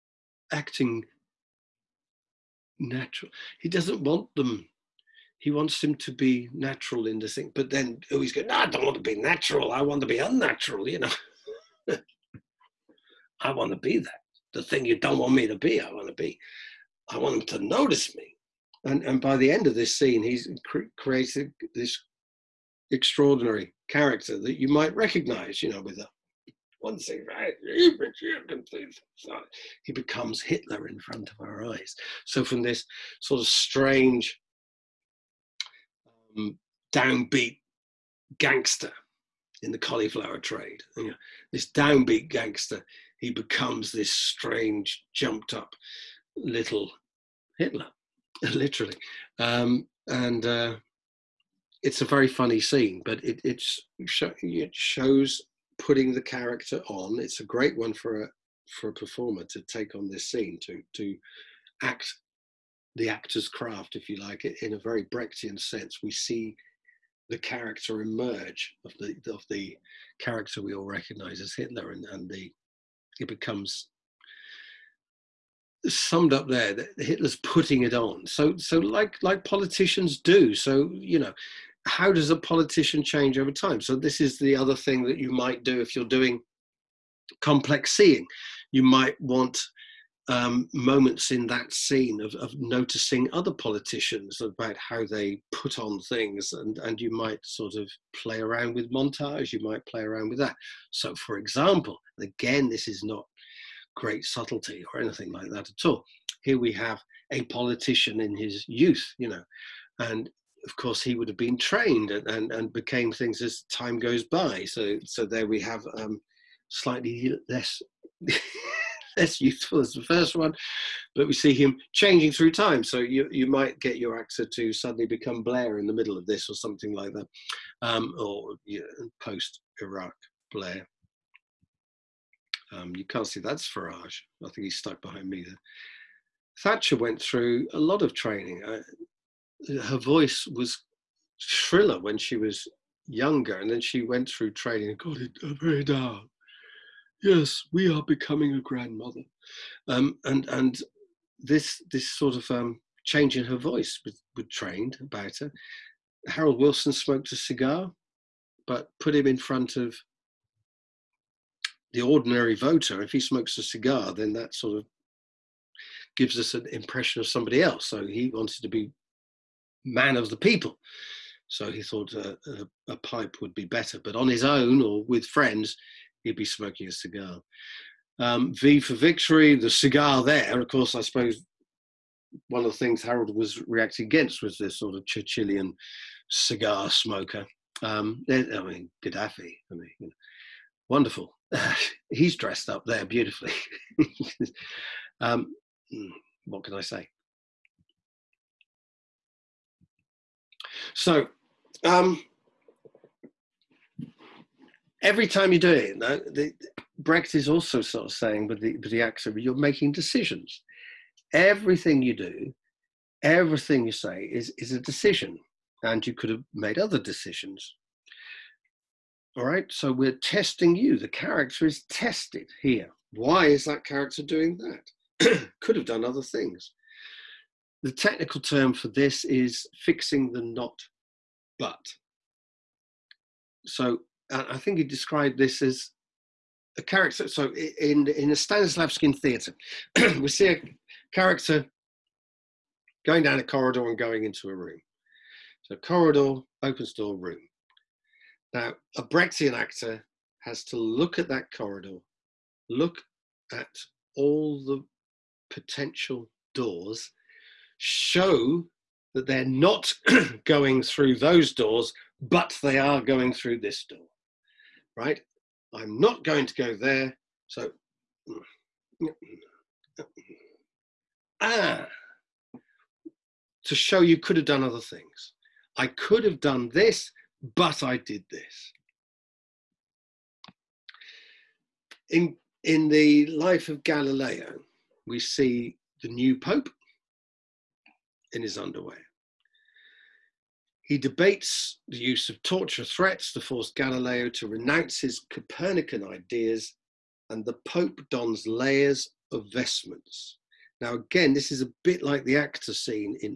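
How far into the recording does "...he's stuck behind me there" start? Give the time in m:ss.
2:14.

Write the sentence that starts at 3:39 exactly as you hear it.
All right, so we're testing you.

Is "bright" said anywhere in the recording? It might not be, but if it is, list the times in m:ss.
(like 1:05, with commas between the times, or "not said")
not said.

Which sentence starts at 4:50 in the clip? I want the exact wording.
He debates the use of torture threats to force Galileo to renounce his Copernican ideas, and the Pope dons layers of vestments.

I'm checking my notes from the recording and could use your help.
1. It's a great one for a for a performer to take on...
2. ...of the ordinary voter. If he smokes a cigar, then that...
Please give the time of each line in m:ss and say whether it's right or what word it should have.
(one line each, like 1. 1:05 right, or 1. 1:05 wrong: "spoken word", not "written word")
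1. 0:57 right
2. 2:39 right.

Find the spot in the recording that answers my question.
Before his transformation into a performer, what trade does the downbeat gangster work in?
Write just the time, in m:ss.
0:39.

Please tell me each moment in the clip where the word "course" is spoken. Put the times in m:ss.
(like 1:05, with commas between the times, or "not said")
1:50, 3:00.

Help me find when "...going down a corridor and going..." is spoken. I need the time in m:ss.
4:03.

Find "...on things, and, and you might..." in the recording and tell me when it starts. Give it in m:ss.
1:35.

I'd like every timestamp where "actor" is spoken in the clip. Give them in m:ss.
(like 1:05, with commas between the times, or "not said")
1:03, 2:04, 4:09, 5:02.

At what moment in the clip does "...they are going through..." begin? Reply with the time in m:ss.
4:22.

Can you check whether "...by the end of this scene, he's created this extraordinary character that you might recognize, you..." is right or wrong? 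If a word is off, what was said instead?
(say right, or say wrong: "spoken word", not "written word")
right.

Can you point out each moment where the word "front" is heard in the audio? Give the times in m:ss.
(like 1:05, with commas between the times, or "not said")
0:30, 2:39.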